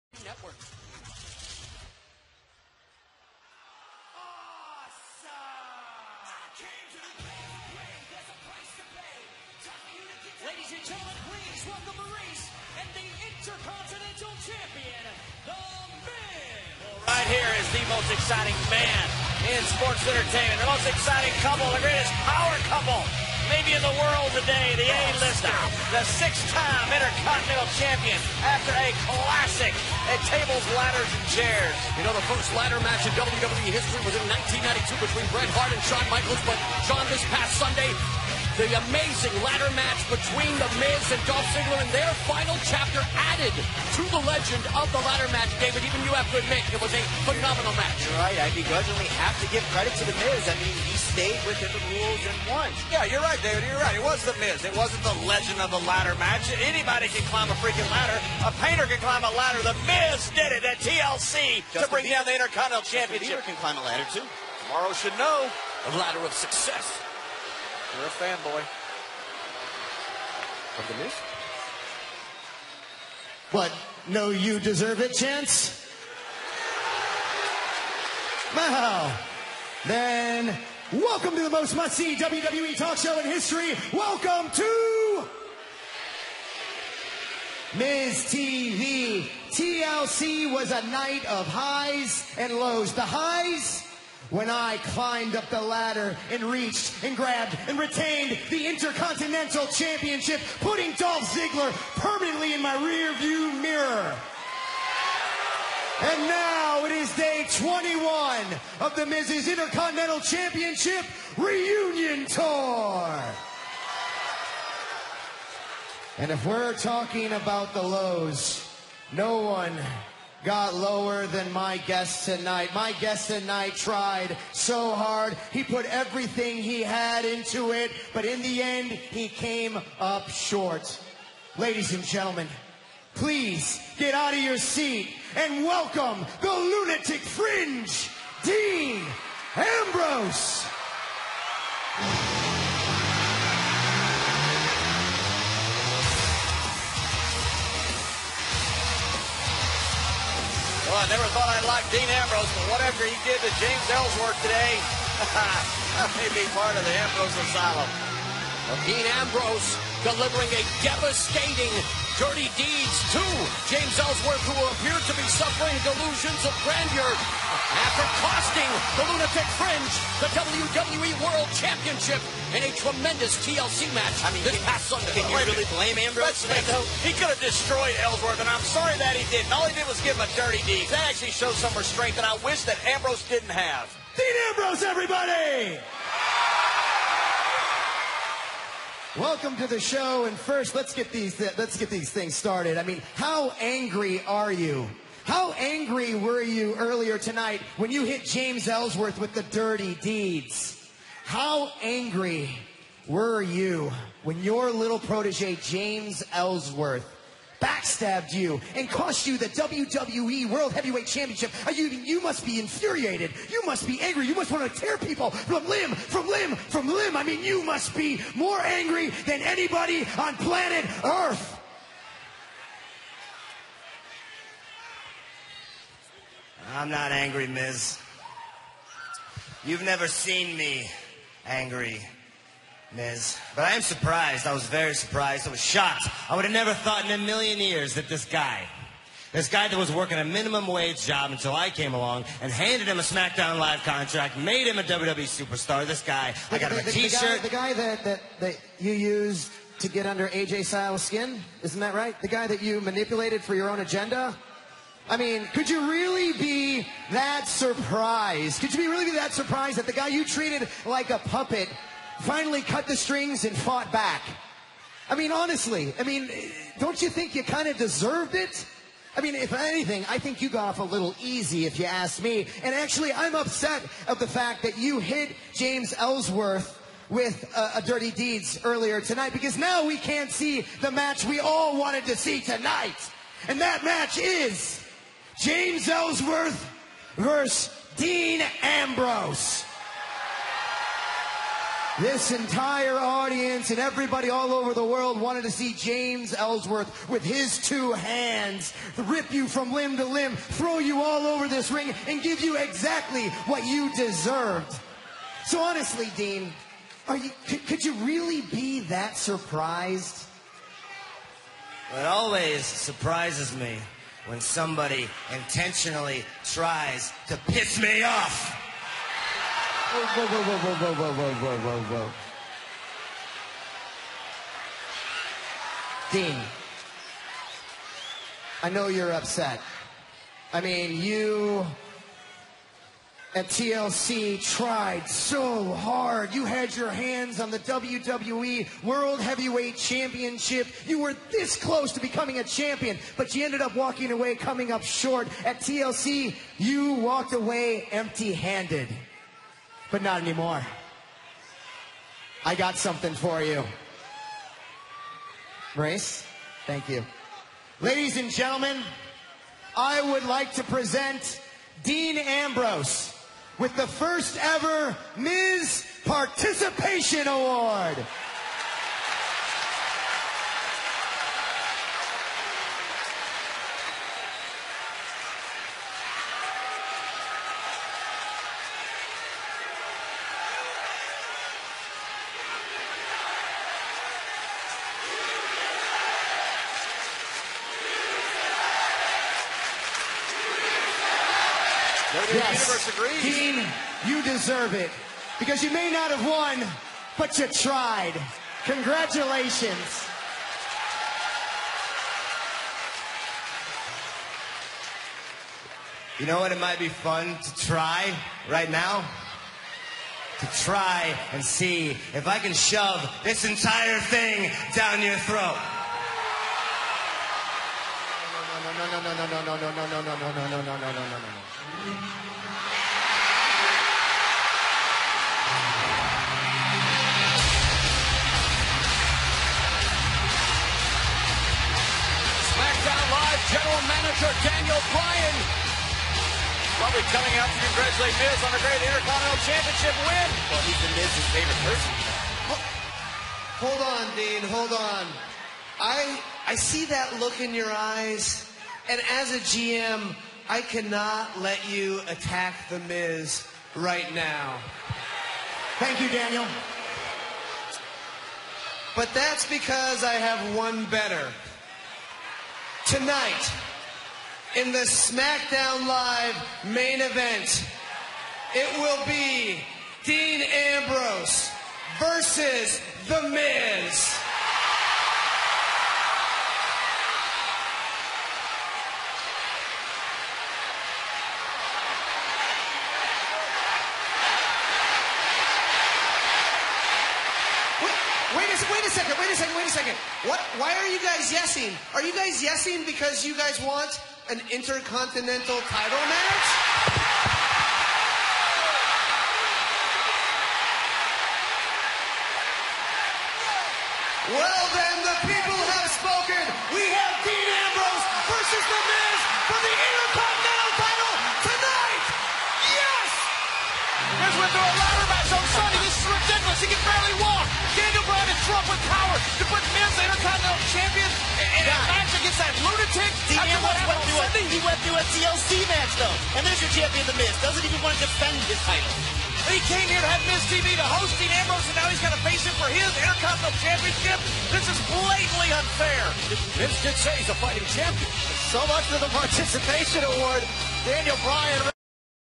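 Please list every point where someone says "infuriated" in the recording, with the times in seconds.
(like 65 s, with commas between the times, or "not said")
212 s.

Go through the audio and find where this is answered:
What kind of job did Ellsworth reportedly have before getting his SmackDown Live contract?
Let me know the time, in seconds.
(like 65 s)
240 s.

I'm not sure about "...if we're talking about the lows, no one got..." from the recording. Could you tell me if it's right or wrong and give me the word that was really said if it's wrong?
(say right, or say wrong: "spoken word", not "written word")
right.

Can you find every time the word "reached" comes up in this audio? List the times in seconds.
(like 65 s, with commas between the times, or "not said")
96 s.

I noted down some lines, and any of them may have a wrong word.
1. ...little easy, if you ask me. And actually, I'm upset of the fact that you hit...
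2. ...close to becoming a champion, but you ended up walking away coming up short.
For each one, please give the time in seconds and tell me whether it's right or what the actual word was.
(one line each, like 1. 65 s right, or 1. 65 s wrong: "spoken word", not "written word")
1. 270 s right
2. 341 s right.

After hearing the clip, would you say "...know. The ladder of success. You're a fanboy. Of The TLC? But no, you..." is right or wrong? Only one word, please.
wrong.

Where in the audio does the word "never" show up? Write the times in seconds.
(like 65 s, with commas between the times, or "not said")
151 s, 229 s, 236 s.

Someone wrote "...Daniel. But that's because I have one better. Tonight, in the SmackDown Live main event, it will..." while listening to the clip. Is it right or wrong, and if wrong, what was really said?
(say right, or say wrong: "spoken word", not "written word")
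right.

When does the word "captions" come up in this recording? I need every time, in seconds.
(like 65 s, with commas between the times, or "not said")
not said.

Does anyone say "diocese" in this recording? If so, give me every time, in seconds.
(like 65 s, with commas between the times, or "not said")
not said.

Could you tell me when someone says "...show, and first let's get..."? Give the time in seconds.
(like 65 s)
189 s.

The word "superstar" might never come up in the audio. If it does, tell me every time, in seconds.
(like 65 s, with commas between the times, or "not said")
245 s.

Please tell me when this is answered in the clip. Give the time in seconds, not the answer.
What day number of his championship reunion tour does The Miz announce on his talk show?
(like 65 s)
107 s.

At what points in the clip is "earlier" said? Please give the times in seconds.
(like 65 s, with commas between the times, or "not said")
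196 s, 278 s.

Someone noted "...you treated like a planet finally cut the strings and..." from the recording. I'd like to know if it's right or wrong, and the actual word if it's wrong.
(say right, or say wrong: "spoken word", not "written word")
wrong: "puppet", not "planet".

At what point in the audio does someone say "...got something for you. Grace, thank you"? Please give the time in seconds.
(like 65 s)
352 s.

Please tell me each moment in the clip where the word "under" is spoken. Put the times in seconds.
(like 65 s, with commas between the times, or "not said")
250 s.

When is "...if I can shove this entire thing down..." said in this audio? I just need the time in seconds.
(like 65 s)
412 s.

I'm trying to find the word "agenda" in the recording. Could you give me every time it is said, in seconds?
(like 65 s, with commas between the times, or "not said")
253 s.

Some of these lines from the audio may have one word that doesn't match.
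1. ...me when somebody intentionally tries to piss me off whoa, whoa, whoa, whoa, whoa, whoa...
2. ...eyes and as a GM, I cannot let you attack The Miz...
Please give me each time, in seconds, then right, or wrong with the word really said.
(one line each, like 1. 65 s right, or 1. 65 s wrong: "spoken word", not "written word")
1. 313 s right
2. 447 s right.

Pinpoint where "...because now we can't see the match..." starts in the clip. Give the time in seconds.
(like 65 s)
279 s.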